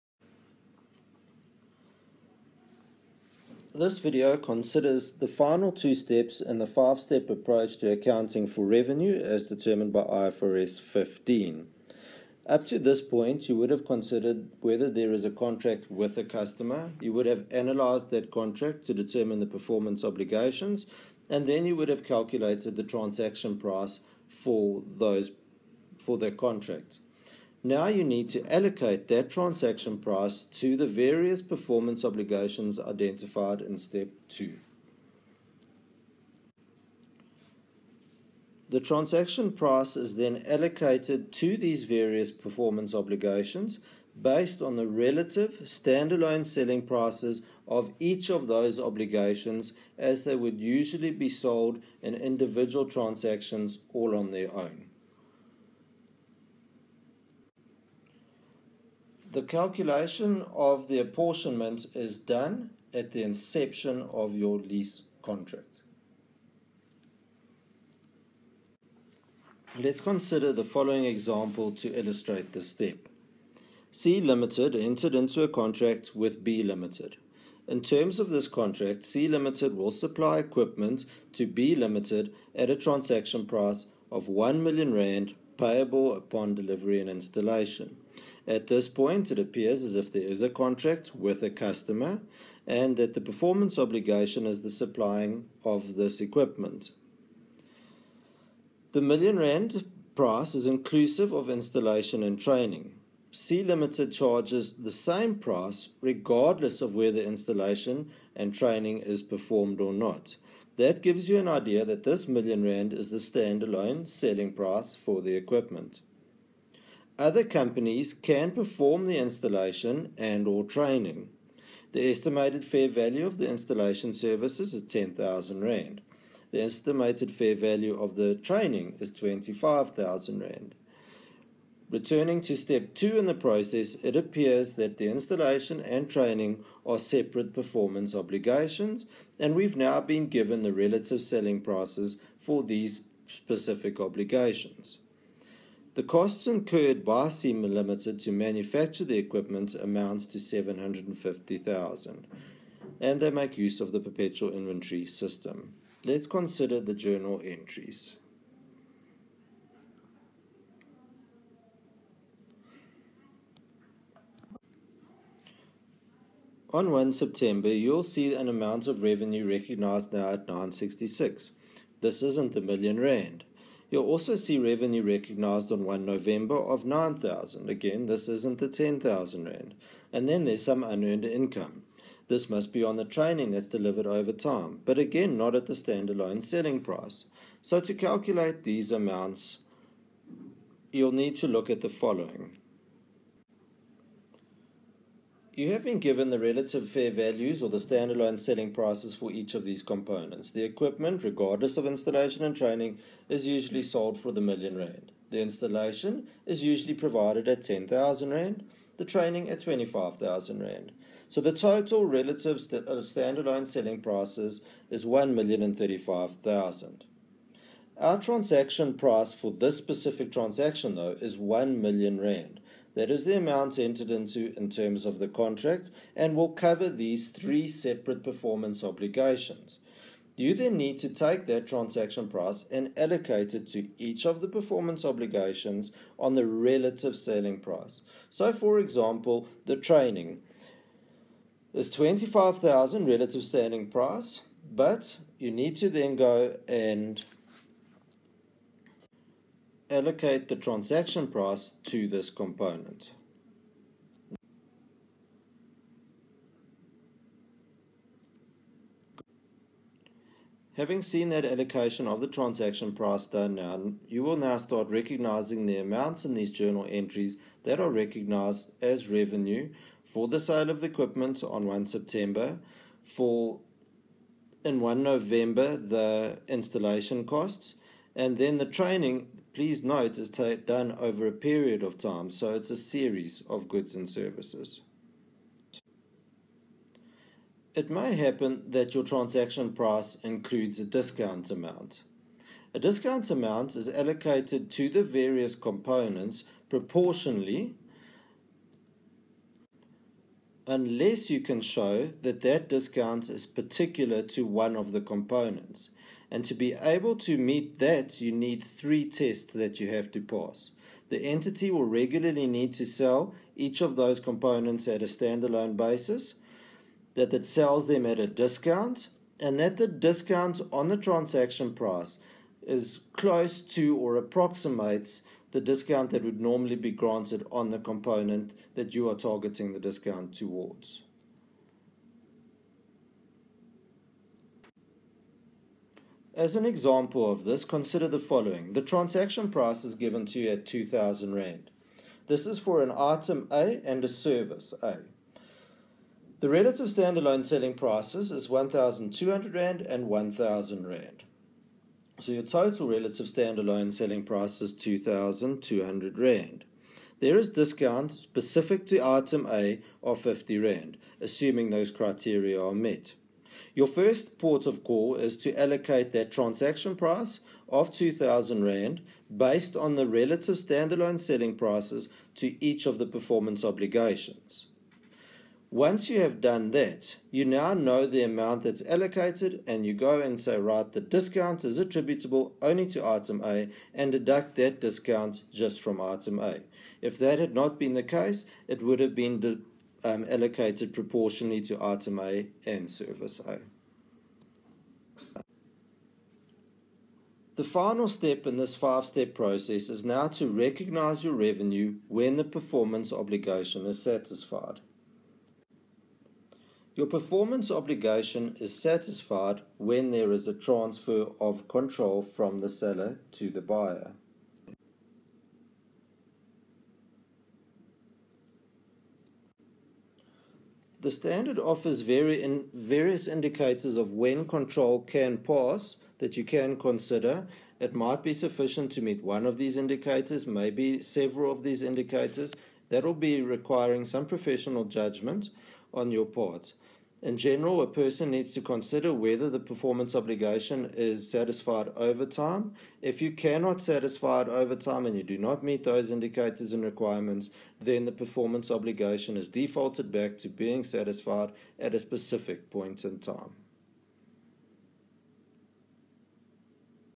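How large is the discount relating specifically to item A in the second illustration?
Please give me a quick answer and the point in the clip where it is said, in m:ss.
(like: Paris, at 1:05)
50 Rand, at 6:00.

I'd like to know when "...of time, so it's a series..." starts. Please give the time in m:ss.
4:41.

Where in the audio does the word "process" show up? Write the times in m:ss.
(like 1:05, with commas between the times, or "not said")
2:13, 6:39.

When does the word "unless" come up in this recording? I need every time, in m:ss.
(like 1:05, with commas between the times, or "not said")
5:00.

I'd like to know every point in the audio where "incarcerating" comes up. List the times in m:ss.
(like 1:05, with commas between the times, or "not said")
not said.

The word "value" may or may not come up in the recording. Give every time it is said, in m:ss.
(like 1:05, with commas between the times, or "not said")
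2:02, 2:07, 3:17.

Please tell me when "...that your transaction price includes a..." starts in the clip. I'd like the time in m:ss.
4:48.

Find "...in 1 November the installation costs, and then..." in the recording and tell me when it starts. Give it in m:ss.
4:34.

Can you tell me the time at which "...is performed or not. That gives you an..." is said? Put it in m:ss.
1:48.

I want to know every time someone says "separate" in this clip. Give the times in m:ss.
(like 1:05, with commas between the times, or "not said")
2:16, 3:47.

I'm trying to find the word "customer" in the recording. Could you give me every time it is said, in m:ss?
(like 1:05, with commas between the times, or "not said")
0:16, 1:31.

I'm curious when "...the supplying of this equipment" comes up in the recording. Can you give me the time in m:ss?
1:34.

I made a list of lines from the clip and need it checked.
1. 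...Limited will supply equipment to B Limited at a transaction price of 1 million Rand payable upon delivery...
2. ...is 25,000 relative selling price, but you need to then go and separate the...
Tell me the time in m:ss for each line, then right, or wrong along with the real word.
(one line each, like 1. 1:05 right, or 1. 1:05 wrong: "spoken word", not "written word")
1. 1:19 right
2. 4:01 wrong: "allocate", not "separate".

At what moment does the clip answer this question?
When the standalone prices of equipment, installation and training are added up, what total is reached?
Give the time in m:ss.
3:35.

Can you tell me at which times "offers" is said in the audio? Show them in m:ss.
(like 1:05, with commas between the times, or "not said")
7:01.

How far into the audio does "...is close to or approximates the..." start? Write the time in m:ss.
5:22.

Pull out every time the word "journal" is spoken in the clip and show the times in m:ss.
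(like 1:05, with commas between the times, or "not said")
2:36, 4:26.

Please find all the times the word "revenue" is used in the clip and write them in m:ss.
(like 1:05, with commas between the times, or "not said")
0:08, 2:49, 2:54, 4:29, 6:41.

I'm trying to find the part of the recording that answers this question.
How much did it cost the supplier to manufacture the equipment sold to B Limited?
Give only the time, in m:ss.
2:30.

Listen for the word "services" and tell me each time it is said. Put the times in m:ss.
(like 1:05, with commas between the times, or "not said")
2:04, 4:44, 5:44, 6:32.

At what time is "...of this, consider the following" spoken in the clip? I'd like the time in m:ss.
5:37.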